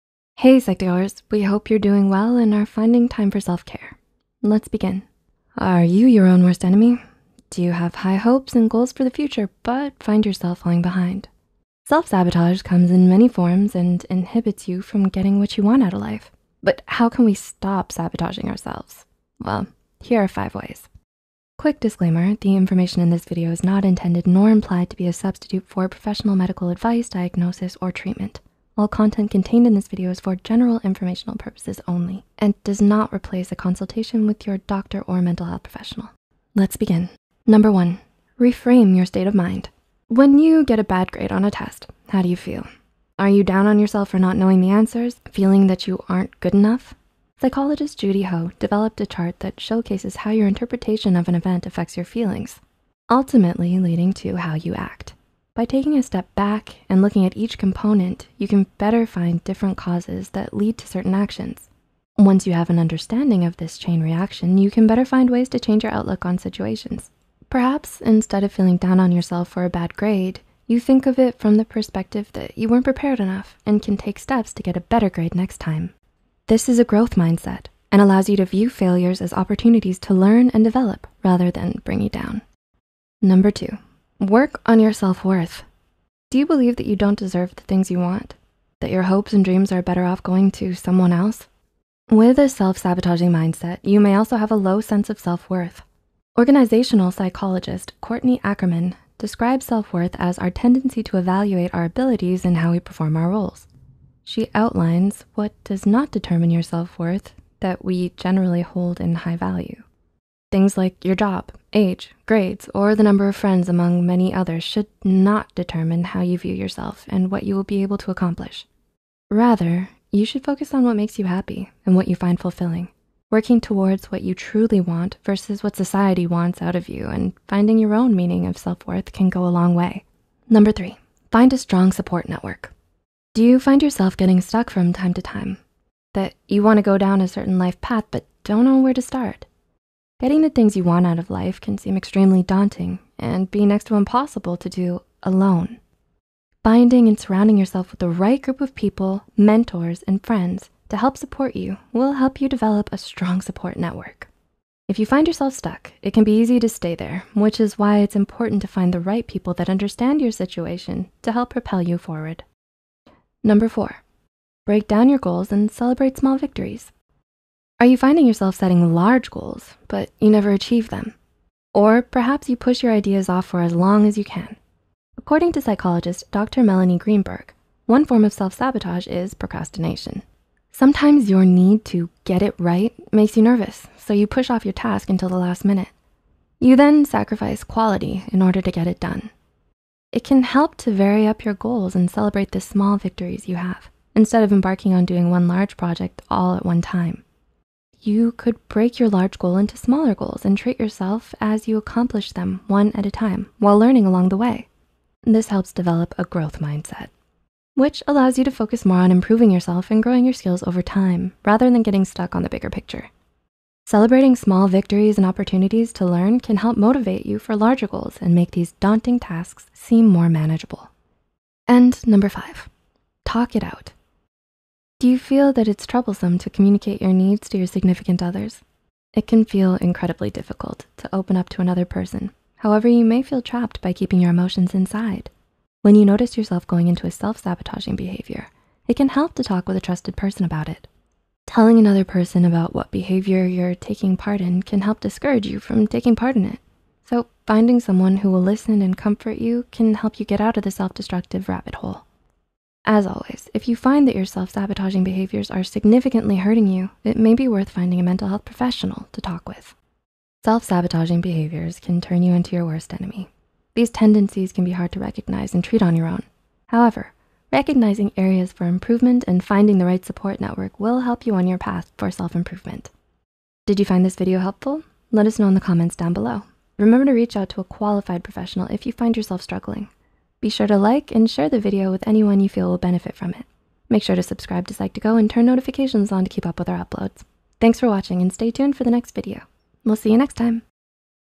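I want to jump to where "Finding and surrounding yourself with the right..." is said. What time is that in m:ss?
2:26.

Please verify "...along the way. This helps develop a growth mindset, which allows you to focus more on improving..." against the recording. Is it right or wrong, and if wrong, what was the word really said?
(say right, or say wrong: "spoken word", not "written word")
right.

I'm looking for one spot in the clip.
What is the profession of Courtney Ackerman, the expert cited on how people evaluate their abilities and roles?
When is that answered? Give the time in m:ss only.
1:36.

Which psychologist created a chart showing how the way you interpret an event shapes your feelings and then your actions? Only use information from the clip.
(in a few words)
Judy Ho.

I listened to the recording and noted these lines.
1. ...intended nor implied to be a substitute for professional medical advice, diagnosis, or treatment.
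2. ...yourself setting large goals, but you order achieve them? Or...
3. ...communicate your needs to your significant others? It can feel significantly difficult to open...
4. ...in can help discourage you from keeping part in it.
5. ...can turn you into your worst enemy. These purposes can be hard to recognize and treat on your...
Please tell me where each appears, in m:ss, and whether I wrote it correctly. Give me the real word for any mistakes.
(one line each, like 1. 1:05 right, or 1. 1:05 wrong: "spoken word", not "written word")
1. 0:23 right
2. 2:48 wrong: "never", not "order"
3. 3:46 wrong: "incredibly", not "significantly"
4. 4:04 wrong: "taking", not "keeping"
5. 4:21 wrong: "tendencies", not "purposes".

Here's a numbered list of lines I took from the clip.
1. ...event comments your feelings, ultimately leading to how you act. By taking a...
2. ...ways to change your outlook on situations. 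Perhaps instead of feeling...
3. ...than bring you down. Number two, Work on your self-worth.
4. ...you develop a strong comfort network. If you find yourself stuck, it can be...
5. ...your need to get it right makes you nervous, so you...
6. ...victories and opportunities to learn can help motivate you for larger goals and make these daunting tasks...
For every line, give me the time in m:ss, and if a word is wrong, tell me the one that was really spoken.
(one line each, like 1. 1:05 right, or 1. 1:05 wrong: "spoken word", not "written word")
1. 0:51 wrong: "affects", not "comments"
2. 1:05 right
3. 1:21 right
4. 2:32 wrong: "support", not "comfort"
5. 3:01 right
6. 3:34 right.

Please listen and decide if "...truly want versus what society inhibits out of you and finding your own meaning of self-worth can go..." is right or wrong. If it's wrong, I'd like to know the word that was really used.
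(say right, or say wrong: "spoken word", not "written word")
wrong: "wants", not "inhibits".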